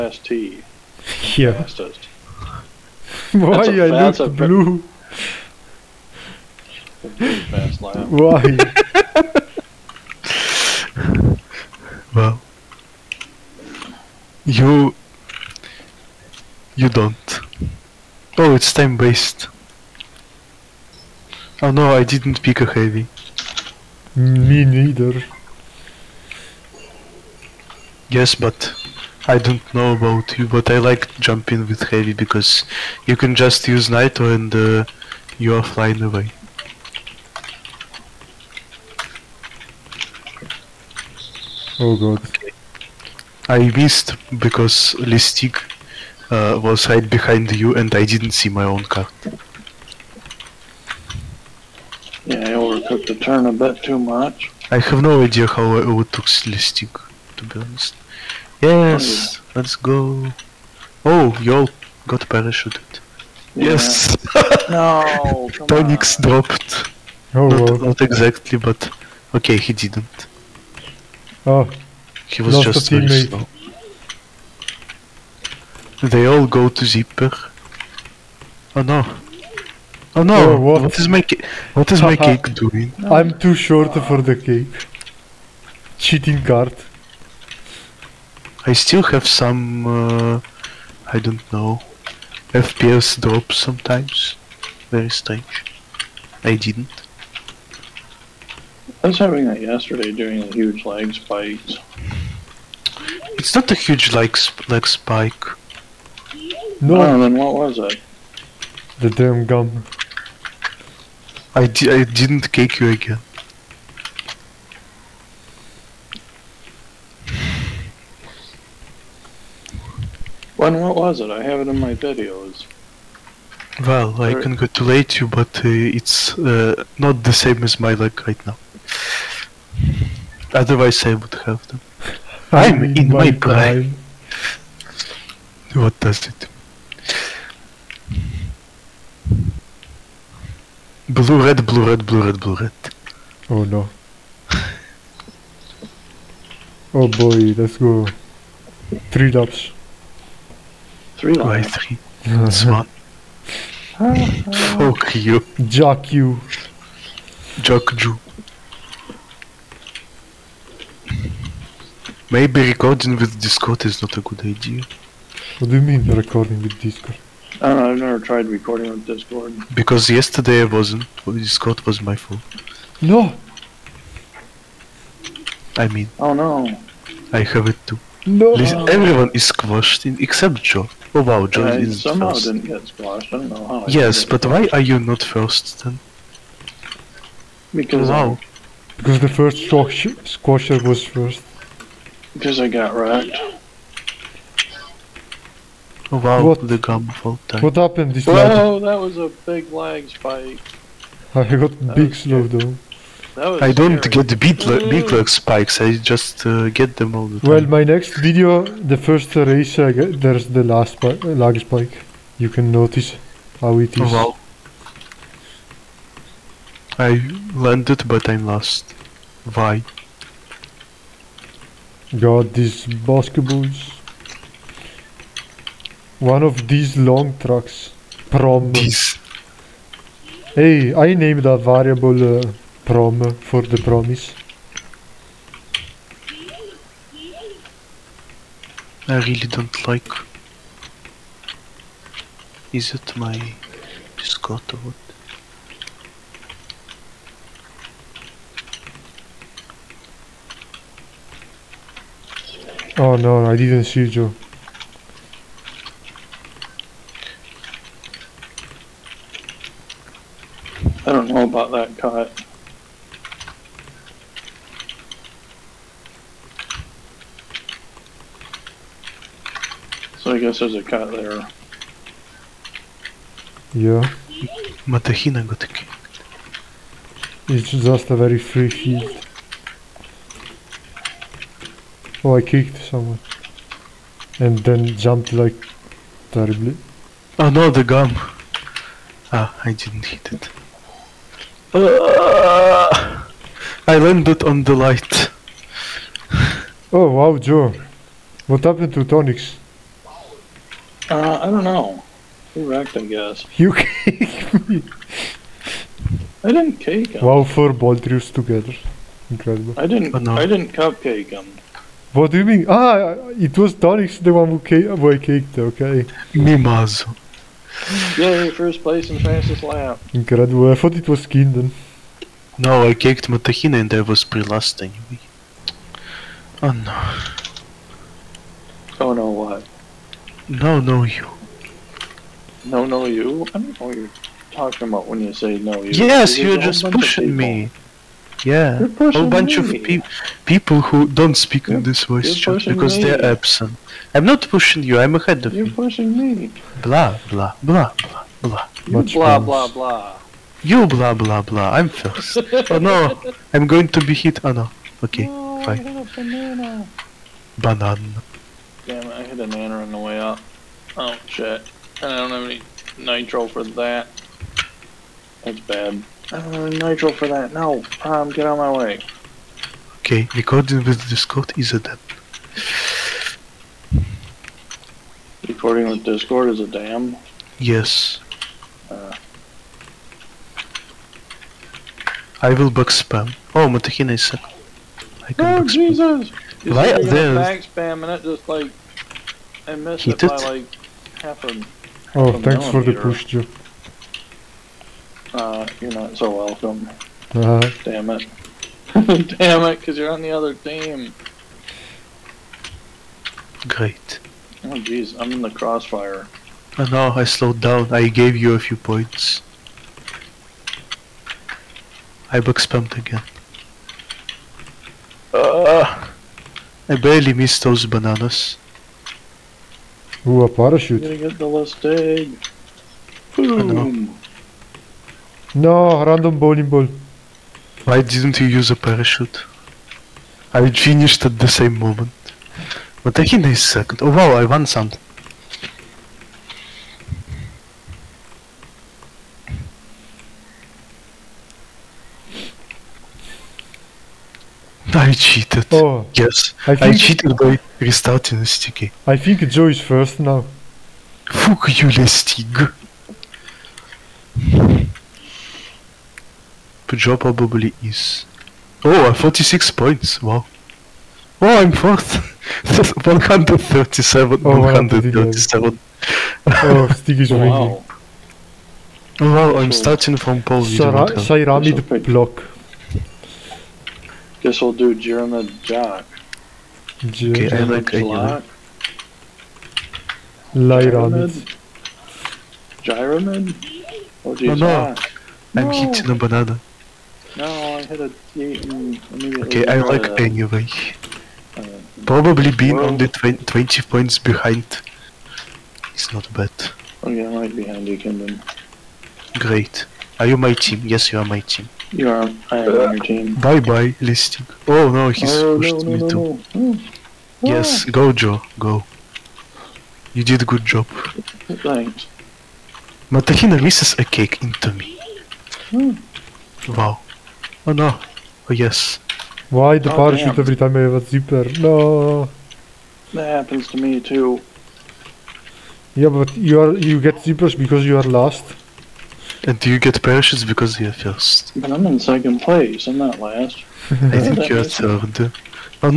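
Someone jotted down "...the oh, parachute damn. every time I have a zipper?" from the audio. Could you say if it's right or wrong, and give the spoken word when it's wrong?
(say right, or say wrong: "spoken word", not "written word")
right.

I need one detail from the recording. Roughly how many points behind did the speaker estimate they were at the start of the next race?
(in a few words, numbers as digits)
20.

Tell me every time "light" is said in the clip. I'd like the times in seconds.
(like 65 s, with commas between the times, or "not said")
294 s, 480 s.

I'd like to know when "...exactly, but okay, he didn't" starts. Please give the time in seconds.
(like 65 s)
68 s.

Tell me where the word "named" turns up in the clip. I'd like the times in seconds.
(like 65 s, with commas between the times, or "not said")
231 s.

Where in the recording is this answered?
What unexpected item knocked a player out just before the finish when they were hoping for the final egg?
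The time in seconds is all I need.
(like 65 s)
426 s.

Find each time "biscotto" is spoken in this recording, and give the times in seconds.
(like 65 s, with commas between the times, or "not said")
244 s.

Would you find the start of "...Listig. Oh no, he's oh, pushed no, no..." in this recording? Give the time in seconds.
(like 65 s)
504 s.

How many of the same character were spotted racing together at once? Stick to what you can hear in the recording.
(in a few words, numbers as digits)
4.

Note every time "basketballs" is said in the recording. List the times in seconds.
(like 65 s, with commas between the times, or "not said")
222 s.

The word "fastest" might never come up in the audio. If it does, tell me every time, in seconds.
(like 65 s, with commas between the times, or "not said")
1 s, 319 s.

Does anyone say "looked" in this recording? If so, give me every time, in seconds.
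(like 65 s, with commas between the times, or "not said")
4 s.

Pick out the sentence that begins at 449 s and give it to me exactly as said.
I think Joe is first now.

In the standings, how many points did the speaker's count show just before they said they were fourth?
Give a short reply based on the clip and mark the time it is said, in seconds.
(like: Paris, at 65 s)
46, at 459 s.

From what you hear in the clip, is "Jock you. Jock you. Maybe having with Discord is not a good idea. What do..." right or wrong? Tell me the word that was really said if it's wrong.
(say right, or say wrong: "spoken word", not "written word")
wrong: "recording", not "having".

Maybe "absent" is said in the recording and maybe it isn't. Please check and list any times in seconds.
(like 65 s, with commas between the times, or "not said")
343 s.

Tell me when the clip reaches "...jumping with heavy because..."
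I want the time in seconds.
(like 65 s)
31 s.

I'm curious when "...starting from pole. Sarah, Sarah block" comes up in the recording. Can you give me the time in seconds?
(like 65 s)
469 s.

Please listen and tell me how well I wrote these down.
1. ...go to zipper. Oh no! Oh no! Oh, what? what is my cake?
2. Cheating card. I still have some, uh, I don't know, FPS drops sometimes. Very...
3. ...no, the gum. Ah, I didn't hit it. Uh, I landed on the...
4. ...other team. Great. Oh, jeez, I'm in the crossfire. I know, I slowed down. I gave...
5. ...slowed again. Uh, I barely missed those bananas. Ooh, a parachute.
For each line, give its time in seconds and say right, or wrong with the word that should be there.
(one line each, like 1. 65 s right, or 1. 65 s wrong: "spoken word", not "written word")
1. 76 s right
2. 85 s right
3. 287 s right
4. 400 s right
5. 412 s wrong: "spammed", not "slowed".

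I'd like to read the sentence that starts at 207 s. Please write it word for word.
Well, my next video, the first race, get, there's the last lag spike.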